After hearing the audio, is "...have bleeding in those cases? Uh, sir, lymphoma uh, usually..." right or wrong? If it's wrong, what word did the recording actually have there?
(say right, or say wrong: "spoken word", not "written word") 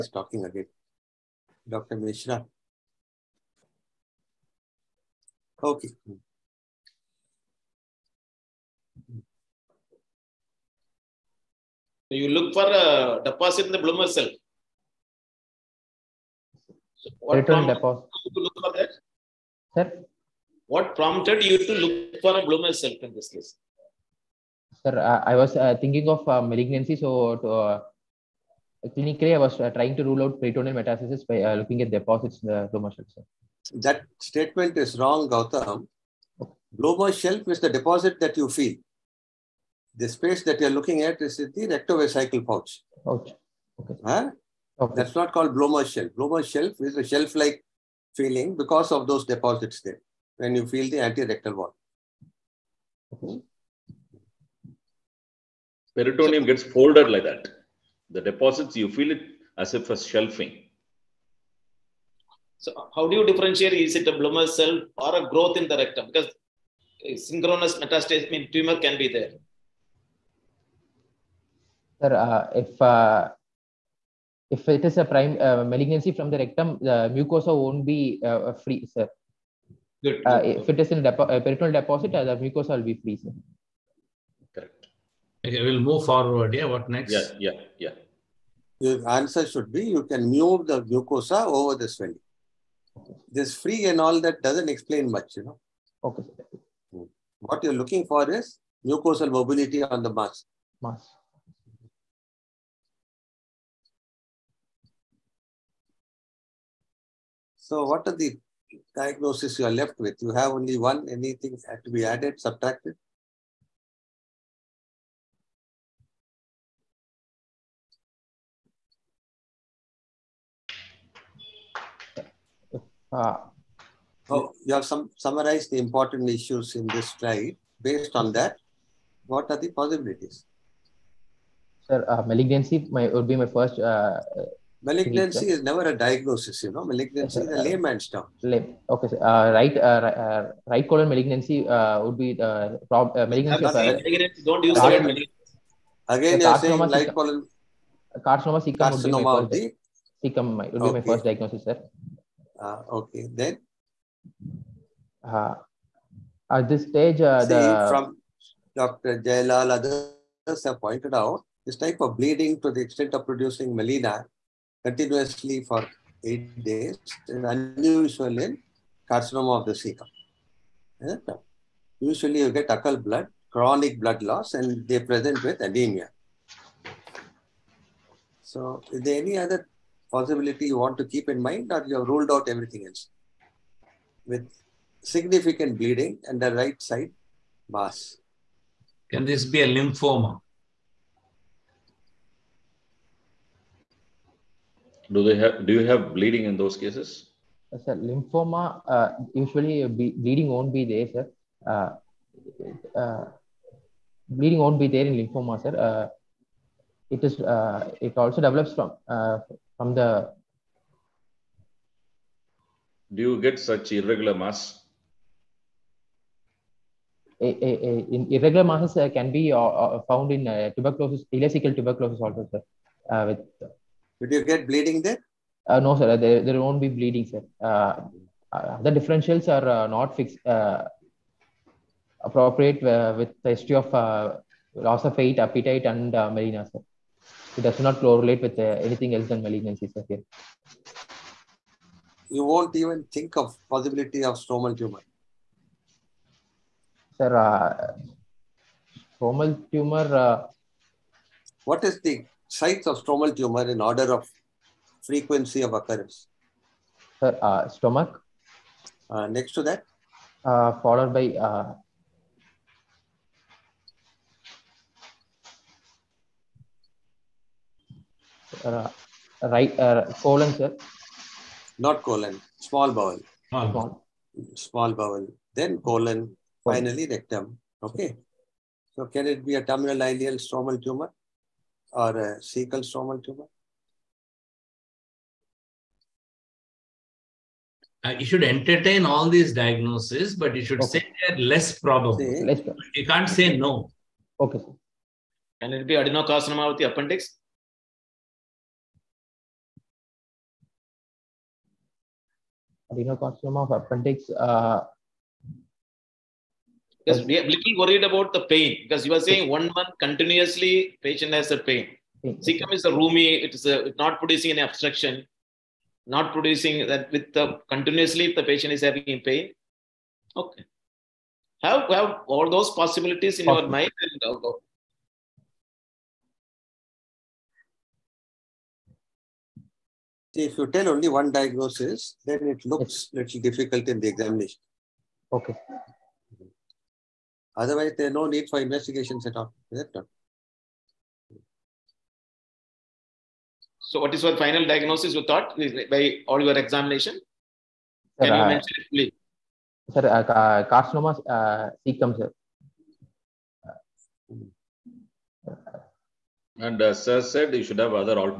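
right.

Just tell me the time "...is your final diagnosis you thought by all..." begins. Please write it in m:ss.
5:44.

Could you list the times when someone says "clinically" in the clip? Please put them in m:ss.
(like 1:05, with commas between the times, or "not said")
0:28.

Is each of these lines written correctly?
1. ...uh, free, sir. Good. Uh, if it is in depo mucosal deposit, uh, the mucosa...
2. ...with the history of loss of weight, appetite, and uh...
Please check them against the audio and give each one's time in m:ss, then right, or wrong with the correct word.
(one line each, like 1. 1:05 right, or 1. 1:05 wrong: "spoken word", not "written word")
1. 1:18 wrong: "peritoneal", not "mucosal"
2. 3:53 right.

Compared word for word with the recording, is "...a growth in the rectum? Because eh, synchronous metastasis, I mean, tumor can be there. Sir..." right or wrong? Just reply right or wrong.
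right.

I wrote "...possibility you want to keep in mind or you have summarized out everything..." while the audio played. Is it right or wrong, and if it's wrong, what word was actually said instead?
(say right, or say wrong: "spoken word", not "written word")
wrong: "ruled", not "summarized".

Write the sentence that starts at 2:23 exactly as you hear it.
Of, Don't use car- Again, so you're saying light colon.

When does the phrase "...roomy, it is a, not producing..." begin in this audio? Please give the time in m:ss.
5:12.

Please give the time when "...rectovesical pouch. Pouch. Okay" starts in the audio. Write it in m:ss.
0:41.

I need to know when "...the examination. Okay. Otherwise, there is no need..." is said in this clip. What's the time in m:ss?
5:33.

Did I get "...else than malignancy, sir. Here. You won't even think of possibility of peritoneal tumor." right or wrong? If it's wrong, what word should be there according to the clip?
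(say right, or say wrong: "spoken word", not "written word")
wrong: "stromal", not "peritoneal".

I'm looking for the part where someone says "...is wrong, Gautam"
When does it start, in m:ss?
0:34.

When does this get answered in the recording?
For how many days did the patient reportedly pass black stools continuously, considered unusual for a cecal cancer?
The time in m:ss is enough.
2:46.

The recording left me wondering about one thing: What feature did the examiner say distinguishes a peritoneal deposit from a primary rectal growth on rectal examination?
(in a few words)
Mucosal mobility.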